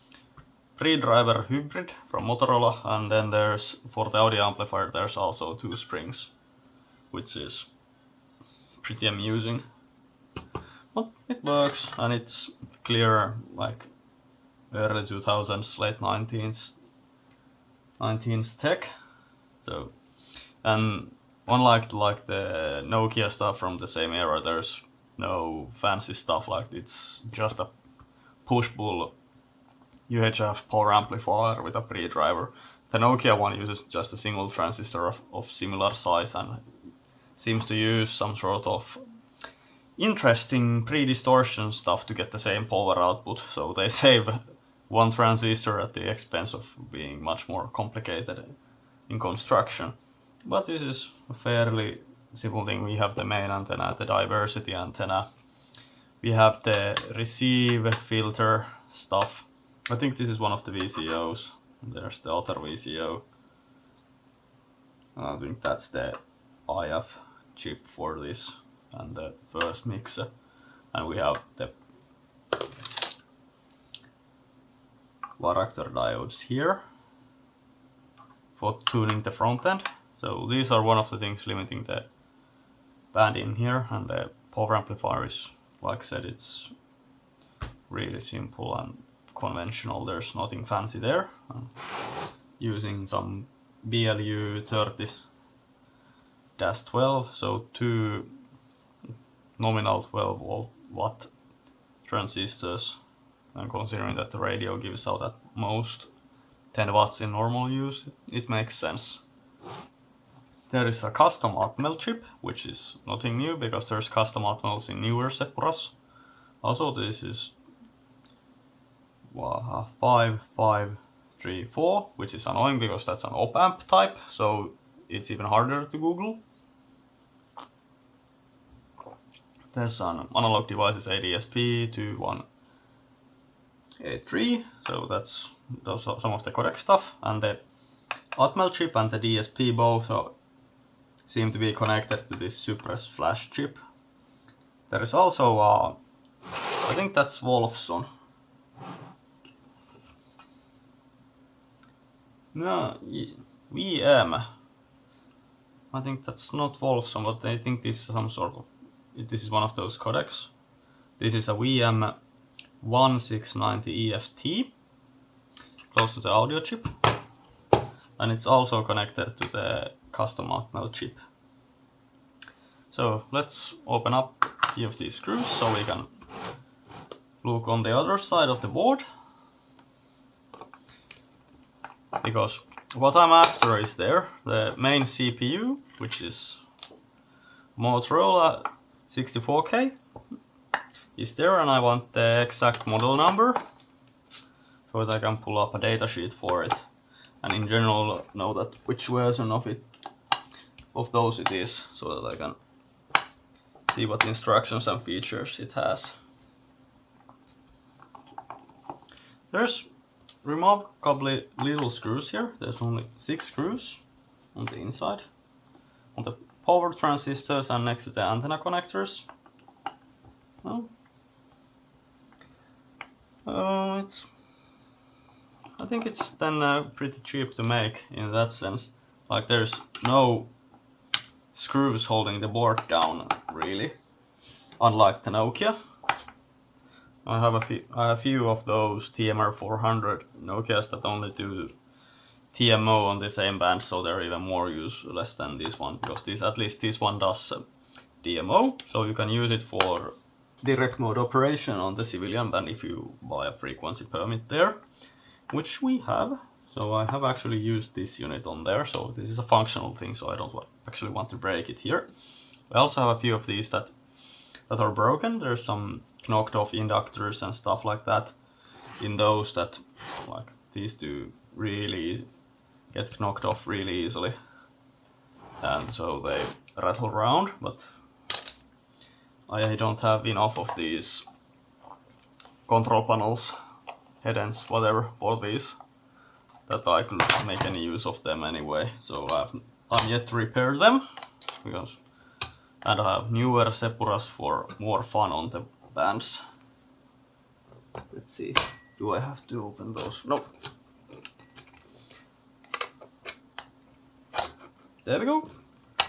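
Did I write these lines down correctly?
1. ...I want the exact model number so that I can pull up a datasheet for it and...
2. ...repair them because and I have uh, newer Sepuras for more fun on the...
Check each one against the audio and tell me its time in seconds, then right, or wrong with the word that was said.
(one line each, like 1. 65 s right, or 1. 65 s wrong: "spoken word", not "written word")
1. 191 s right
2. 290 s right.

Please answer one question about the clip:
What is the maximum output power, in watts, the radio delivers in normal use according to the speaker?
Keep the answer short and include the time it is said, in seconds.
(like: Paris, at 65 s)
10 watts, at 106 s.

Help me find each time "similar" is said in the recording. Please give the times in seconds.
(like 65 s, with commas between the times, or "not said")
35 s.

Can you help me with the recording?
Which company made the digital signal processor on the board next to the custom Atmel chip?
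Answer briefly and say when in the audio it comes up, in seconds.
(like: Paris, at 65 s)
Analog Devices, at 130 s.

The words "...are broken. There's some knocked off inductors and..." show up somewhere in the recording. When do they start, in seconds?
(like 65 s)
264 s.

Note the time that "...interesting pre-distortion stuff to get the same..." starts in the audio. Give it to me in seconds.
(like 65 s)
39 s.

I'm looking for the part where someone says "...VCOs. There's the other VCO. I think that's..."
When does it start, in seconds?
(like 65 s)
60 s.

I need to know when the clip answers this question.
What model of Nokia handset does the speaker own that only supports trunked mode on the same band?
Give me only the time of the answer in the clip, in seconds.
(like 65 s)
239 s.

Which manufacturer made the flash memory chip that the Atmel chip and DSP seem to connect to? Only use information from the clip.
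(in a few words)
Cypress.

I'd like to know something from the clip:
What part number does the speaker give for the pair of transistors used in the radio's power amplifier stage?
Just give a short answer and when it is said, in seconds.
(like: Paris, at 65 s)
BLU 30-12, at 93 s.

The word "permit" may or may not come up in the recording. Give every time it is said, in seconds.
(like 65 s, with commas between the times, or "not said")
254 s.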